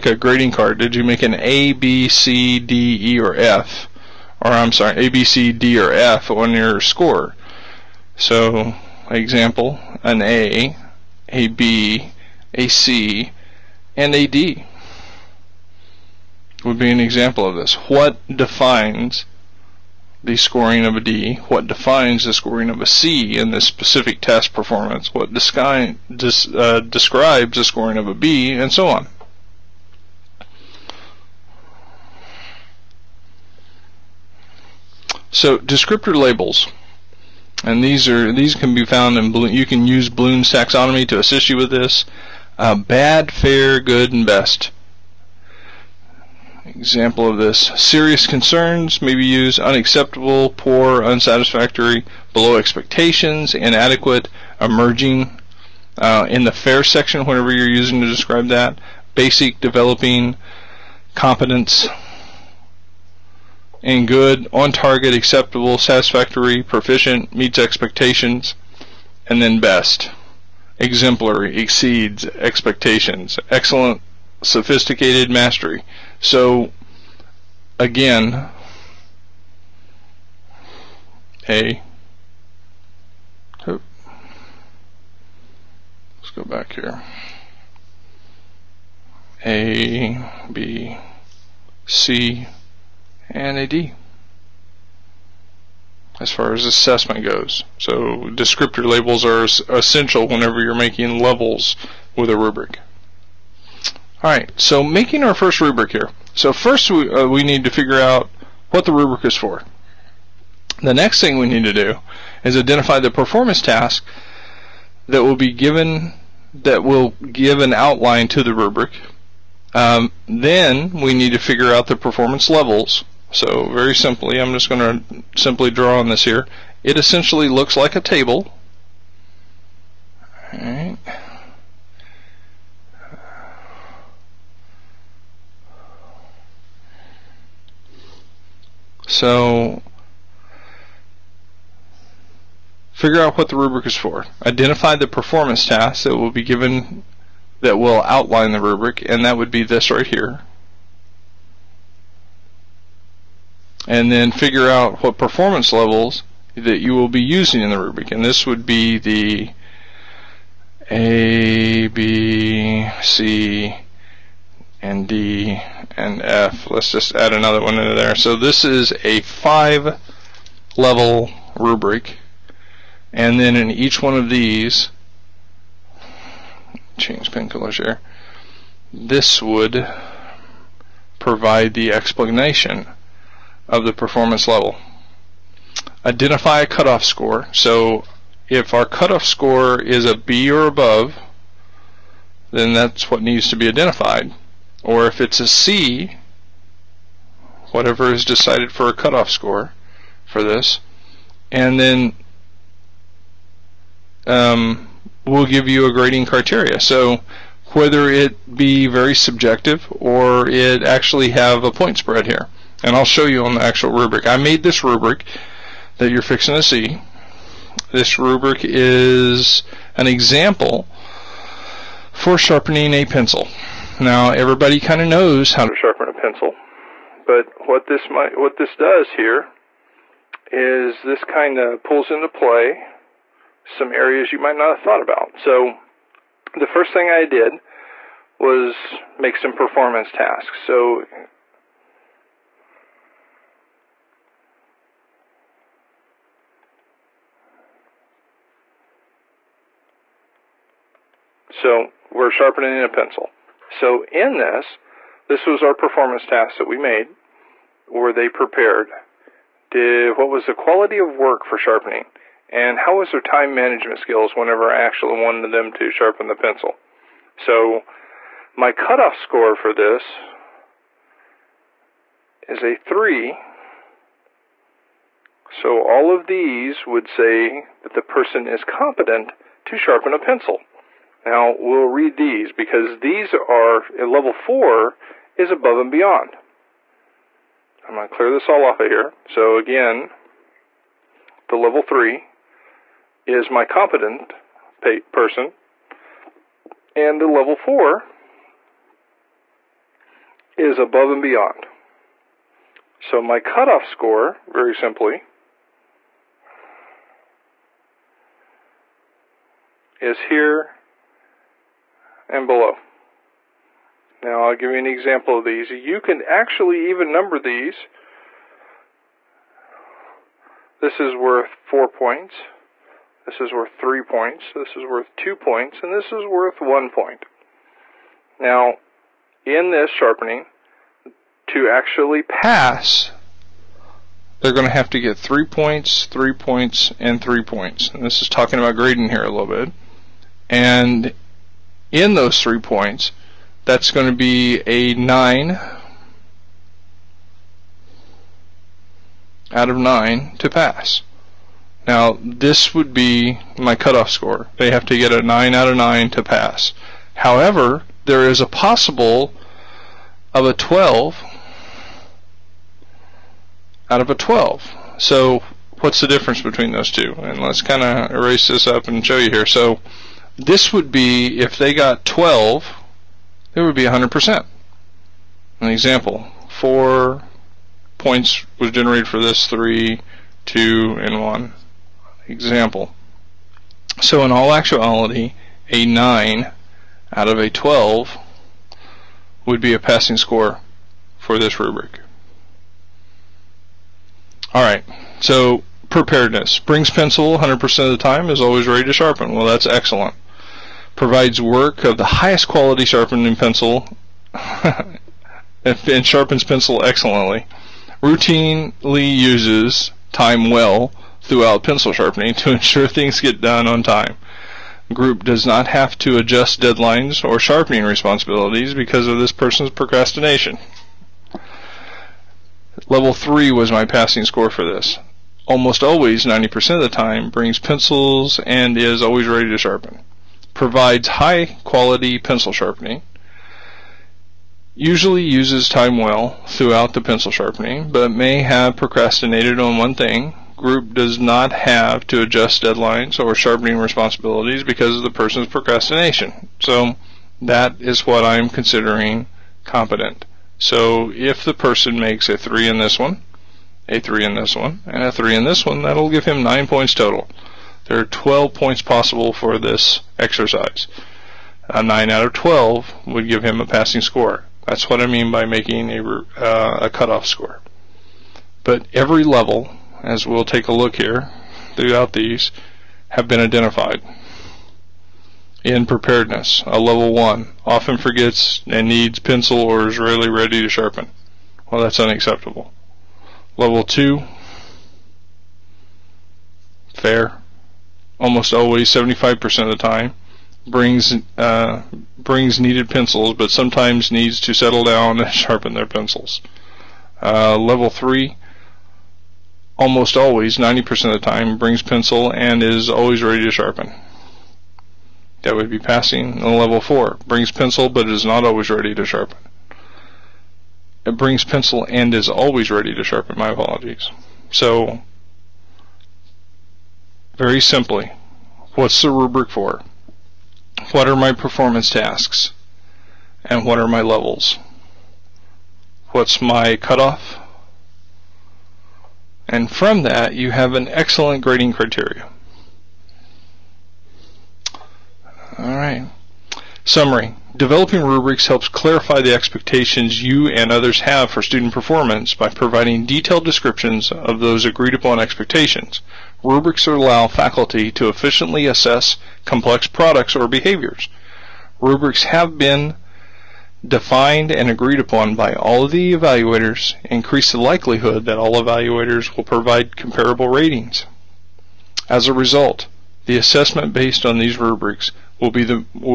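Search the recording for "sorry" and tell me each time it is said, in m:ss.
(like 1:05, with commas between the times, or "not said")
0:04.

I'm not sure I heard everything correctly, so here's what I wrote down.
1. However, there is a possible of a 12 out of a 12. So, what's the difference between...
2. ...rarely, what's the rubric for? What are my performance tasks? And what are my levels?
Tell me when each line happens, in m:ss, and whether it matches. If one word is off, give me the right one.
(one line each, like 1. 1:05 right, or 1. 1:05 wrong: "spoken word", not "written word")
1. 5:57 right
2. 8:37 wrong: "simply", not "rarely".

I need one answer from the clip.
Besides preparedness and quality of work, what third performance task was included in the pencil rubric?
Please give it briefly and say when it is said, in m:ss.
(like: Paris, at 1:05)
Time management skills, at 4:23.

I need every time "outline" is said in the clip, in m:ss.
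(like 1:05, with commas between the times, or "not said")
1:57, 2:28.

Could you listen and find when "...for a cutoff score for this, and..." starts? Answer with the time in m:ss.
3:18.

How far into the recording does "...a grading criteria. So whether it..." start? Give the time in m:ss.
3:25.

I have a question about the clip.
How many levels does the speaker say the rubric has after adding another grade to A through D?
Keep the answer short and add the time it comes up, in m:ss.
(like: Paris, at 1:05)
5, at 2:49.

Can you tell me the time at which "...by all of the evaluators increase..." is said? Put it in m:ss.
9:15.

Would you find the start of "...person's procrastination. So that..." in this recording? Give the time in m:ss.
7:25.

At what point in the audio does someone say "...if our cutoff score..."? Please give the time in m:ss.
3:08.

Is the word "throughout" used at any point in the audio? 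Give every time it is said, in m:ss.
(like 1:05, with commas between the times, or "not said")
6:51, 7:16, 7:51.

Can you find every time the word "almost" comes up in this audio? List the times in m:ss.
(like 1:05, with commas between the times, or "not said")
7:05, 8:08, 8:19.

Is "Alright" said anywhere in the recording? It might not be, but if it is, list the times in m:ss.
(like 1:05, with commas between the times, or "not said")
1:44, 6:34.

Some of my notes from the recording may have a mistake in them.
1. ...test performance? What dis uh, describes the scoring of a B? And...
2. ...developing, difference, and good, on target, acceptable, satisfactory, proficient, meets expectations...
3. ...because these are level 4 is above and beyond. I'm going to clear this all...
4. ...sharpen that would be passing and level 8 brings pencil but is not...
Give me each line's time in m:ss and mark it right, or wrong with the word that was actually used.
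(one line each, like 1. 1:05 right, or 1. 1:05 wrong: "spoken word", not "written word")
1. 0:24 right
2. 0:59 wrong: "competence", not "difference"
3. 4:42 right
4. 8:23 wrong: "4", not "8".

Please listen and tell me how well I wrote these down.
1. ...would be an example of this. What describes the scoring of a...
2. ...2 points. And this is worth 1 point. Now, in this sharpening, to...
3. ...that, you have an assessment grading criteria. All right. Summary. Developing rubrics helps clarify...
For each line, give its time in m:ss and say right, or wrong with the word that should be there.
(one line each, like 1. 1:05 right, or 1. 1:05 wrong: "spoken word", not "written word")
1. 0:16 wrong: "defines", not "describes"
2. 5:25 right
3. 8:50 wrong: "excellent", not "assessment".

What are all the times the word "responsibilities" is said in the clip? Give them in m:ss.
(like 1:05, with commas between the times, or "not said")
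6:57, 7:23.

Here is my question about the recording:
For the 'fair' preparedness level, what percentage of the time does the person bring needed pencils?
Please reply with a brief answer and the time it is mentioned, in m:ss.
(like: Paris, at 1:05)
75%, at 8:08.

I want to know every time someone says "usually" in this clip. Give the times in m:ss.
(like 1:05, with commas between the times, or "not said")
7:14.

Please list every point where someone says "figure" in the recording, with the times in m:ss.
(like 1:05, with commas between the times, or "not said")
1:47, 2:01, 2:22, 2:34.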